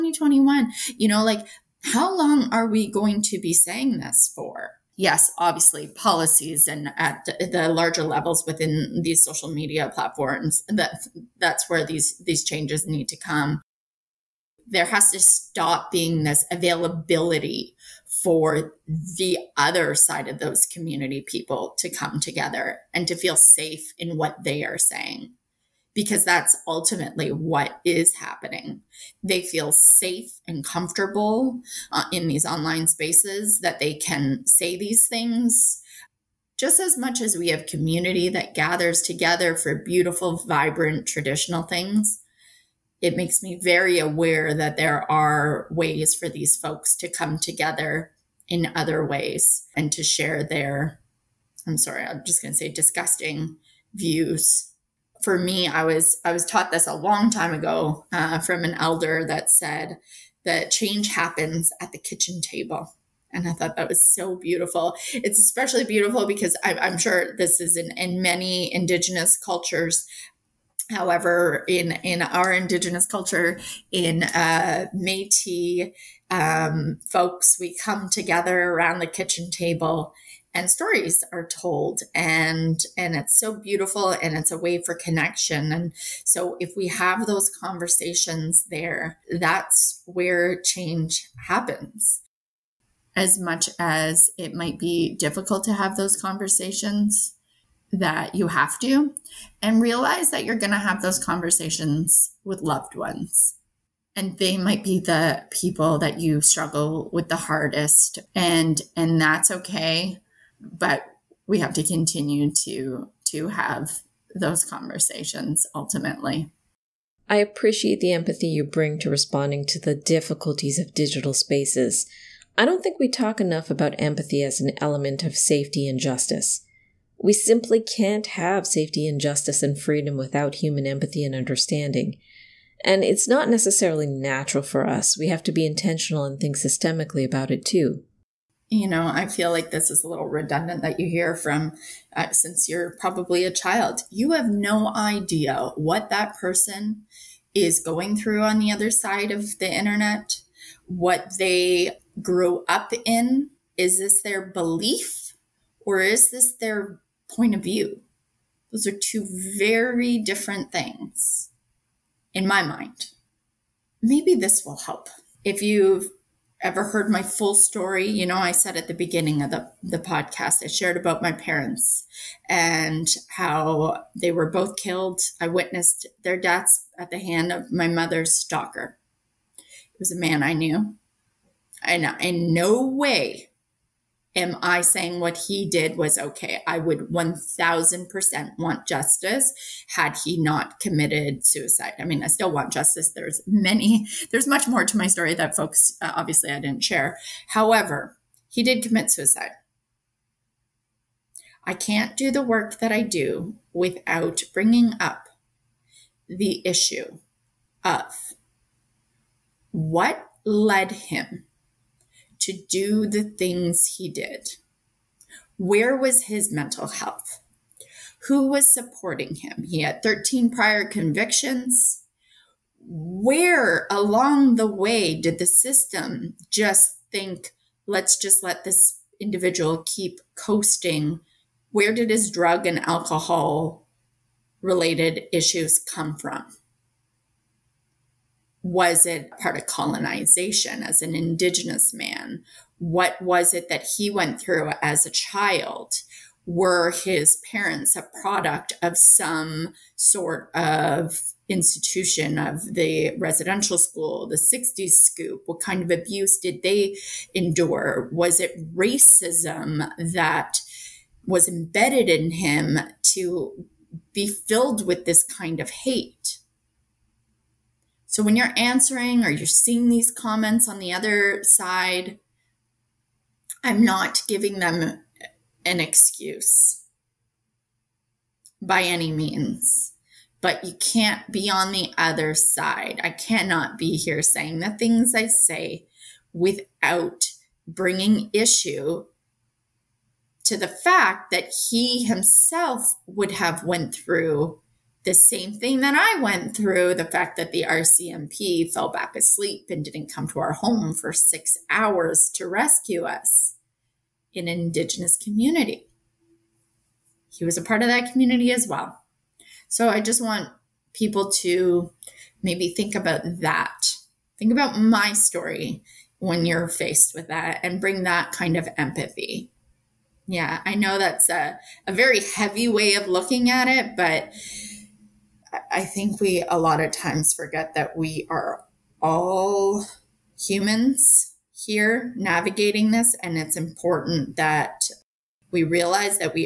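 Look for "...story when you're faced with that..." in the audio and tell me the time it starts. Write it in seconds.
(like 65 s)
315 s.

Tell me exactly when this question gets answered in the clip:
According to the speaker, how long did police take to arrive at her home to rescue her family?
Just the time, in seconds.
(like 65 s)
301 s.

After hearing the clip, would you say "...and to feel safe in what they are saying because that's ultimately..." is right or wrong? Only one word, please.
right.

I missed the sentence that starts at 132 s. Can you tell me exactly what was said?
And it's not necessarily natural for us.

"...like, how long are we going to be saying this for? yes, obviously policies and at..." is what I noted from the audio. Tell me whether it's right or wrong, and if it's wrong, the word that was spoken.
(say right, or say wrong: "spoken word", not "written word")
right.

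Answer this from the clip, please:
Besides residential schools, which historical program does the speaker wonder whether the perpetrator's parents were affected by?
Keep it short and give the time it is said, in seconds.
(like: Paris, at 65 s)
60s Scoop, at 254 s.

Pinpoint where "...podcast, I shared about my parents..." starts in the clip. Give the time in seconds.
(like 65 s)
169 s.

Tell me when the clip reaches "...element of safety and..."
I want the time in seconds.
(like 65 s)
124 s.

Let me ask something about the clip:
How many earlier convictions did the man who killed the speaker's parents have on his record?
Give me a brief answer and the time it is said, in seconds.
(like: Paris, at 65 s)
13, at 220 s.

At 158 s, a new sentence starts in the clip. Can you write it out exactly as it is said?
Those are two very different things in my mind.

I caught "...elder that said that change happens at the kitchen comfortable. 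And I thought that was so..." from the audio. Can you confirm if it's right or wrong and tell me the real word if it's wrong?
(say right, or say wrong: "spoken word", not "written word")
wrong: "table", not "comfortable".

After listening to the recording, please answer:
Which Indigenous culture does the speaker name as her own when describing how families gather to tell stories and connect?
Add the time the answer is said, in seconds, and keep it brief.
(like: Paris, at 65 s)
Métis, at 74 s.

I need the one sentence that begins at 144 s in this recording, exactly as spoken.
You have no idea what that person is going through on the other side of the internet, what they grew up in.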